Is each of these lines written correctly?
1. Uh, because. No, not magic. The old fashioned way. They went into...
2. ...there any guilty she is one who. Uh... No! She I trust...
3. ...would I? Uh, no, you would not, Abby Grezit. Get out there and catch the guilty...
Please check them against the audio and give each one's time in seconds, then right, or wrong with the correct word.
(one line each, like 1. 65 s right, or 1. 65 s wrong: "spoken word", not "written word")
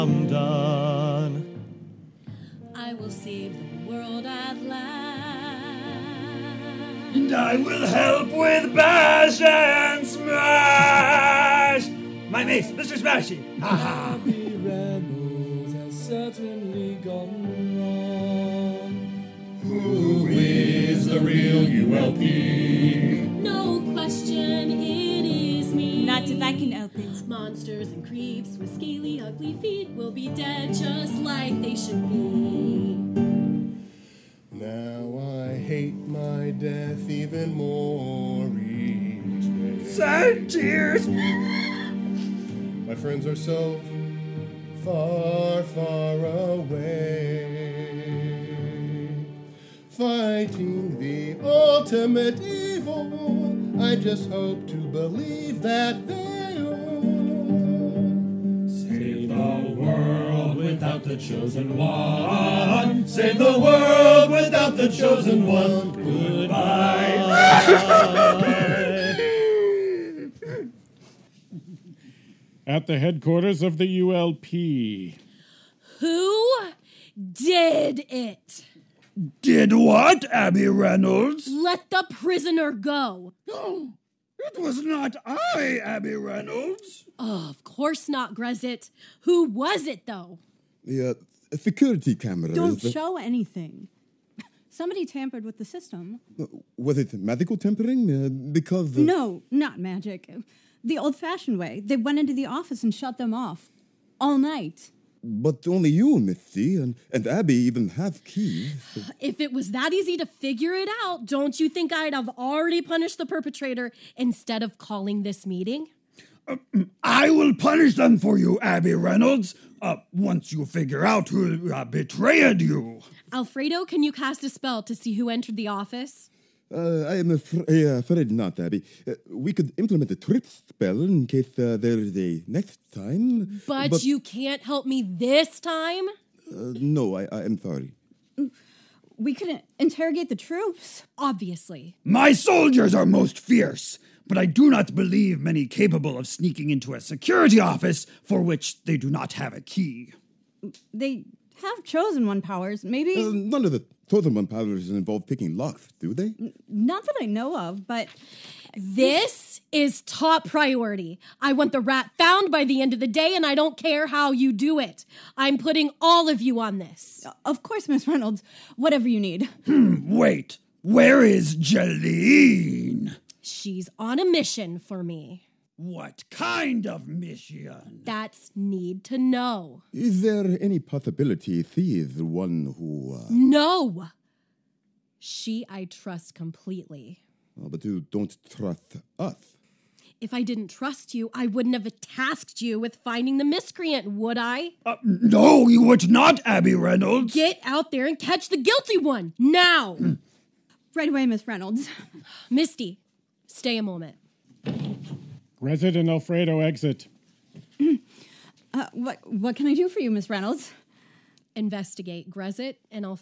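1. 98 s right
2. 180 s wrong: "possibility", not "guilty"
3. 194 s wrong: "Reynolds", not "Grezit".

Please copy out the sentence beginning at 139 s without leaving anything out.
We couldn't interrogate the troops, obviously.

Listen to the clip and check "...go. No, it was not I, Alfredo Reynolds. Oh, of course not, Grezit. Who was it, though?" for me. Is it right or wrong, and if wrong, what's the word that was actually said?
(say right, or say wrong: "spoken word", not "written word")
wrong: "Abby", not "Alfredo".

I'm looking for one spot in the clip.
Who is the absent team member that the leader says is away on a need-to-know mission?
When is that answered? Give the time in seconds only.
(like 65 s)
171 s.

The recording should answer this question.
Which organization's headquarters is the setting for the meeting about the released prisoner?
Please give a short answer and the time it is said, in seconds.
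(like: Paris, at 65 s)
ULP, at 74 s.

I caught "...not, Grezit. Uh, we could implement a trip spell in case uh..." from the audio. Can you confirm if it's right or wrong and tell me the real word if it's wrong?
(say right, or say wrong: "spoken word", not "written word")
wrong: "Abby", not "Grezit".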